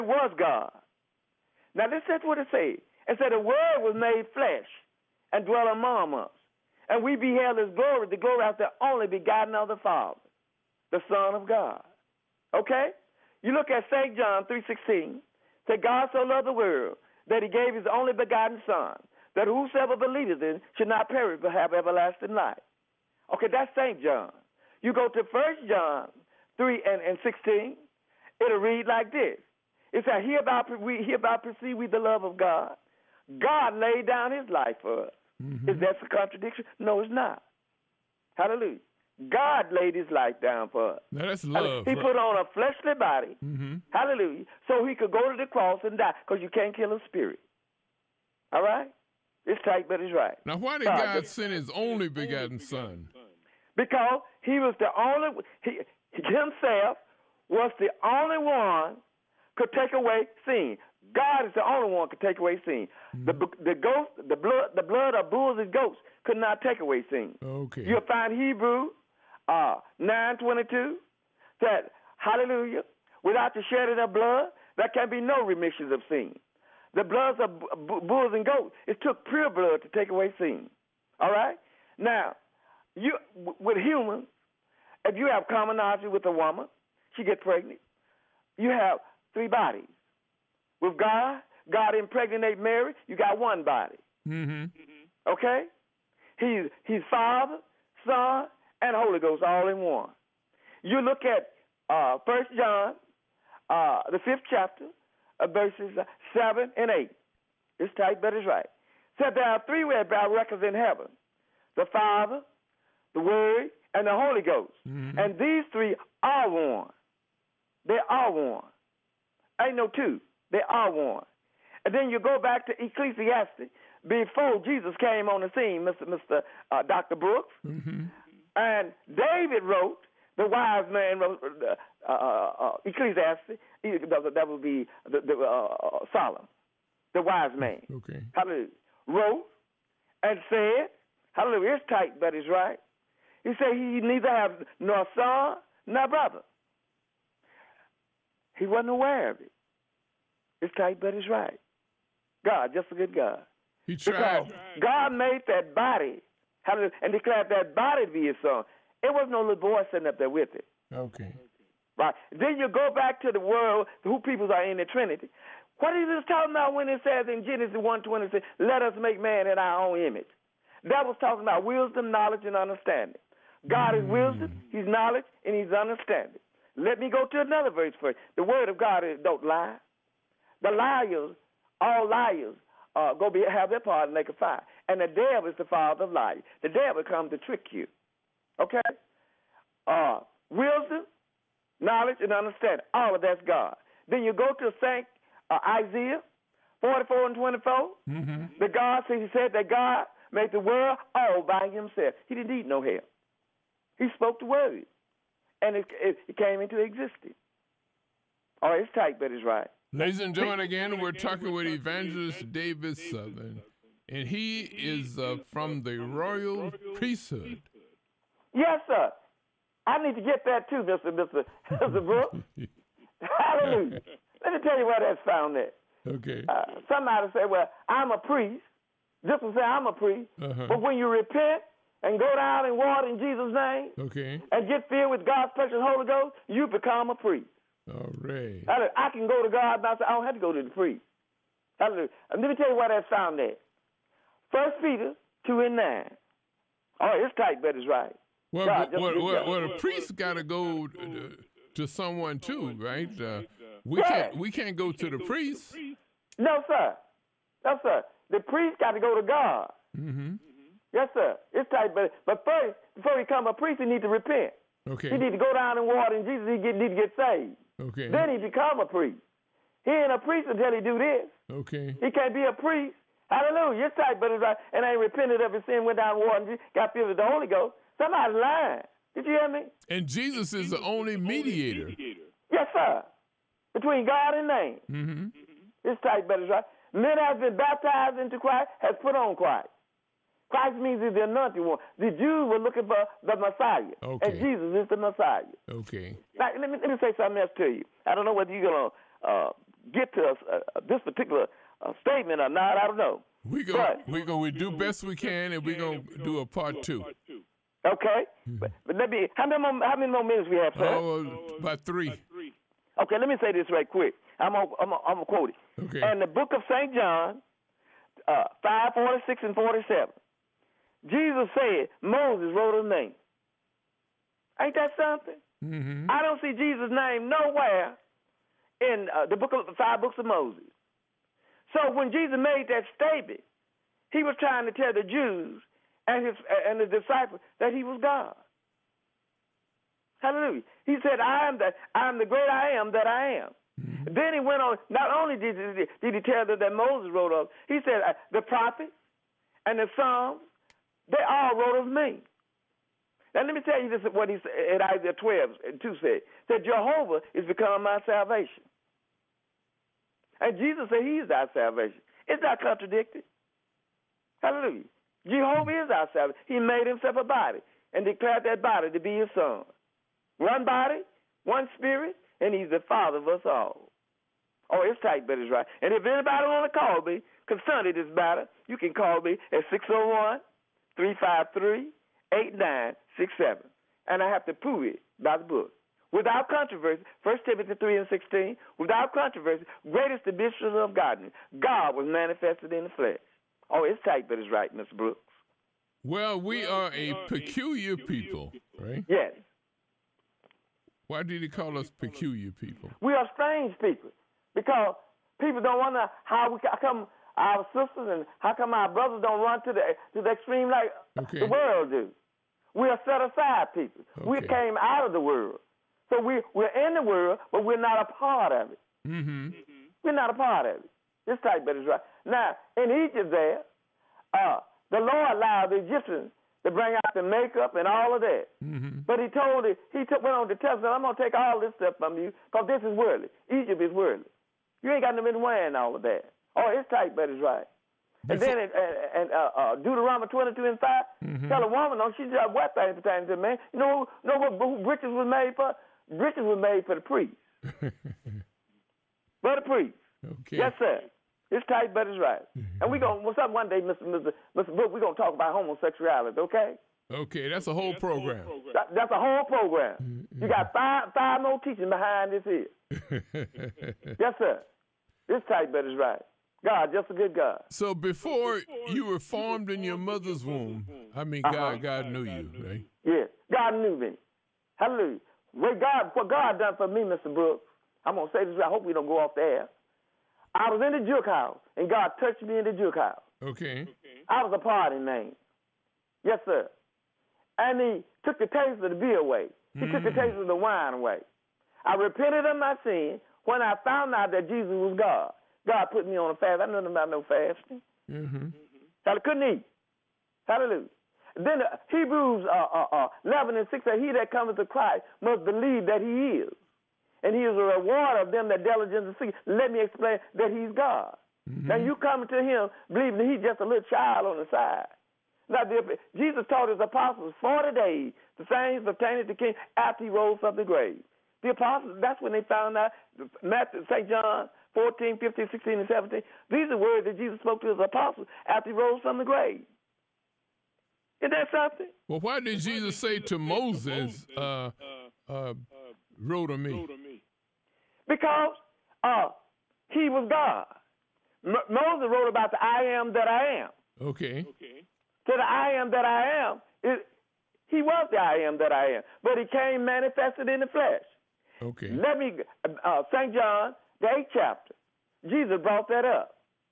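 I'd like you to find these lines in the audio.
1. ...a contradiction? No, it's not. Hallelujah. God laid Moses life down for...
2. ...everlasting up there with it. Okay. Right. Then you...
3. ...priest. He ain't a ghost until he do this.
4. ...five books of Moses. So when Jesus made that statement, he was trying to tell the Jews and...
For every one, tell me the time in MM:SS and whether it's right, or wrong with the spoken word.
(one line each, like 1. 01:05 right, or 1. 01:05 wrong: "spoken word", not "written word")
1. 00:36 wrong: "His", not "Moses"
2. 02:39 wrong: "sitting", not "everlasting"
3. 04:28 wrong: "priest", not "ghost"
4. 05:29 right.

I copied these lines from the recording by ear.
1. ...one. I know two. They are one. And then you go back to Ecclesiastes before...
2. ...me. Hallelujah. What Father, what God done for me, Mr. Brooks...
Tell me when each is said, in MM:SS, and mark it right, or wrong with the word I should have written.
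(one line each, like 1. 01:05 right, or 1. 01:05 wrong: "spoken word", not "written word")
1. 01:58 right
2. 07:53 wrong: "God", not "Father".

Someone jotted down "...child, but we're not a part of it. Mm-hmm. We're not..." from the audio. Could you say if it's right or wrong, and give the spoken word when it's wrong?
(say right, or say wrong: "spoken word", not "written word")
wrong: "world", not "child".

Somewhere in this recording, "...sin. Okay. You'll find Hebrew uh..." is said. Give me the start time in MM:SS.
01:07.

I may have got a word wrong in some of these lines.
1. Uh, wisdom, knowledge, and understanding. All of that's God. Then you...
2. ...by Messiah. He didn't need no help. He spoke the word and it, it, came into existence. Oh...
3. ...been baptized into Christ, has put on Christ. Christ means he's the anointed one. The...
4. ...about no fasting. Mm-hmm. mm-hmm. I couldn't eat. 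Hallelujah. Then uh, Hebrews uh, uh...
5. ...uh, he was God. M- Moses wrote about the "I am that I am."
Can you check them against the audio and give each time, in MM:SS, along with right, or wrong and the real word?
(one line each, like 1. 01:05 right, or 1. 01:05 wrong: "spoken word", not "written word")
1. 03:09 right
2. 03:21 wrong: "Himself", not "Messiah"
3. 04:47 right
4. 08:16 right
5. 08:59 right.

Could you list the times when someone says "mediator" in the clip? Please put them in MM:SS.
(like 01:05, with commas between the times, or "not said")
04:41.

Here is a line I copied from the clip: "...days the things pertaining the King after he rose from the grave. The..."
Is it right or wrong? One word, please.
right.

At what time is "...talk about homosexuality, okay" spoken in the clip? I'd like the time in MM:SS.
07:35.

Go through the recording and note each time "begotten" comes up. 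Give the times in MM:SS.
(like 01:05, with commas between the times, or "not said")
00:09, 00:18, 00:52.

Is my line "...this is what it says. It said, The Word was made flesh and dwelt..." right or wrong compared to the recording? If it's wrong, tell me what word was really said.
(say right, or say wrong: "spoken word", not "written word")
right.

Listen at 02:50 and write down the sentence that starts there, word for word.
That was talking about wisdom, knowledge, and understanding.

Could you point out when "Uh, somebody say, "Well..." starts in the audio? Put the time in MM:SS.
03:46.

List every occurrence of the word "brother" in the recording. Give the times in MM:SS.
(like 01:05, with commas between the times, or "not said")
02:26, 06:48.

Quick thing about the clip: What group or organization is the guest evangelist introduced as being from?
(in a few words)
The royal priesthood.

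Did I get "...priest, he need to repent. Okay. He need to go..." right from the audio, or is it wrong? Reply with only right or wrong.
right.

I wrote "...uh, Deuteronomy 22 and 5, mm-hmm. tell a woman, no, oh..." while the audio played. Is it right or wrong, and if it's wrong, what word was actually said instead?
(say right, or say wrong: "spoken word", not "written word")
right.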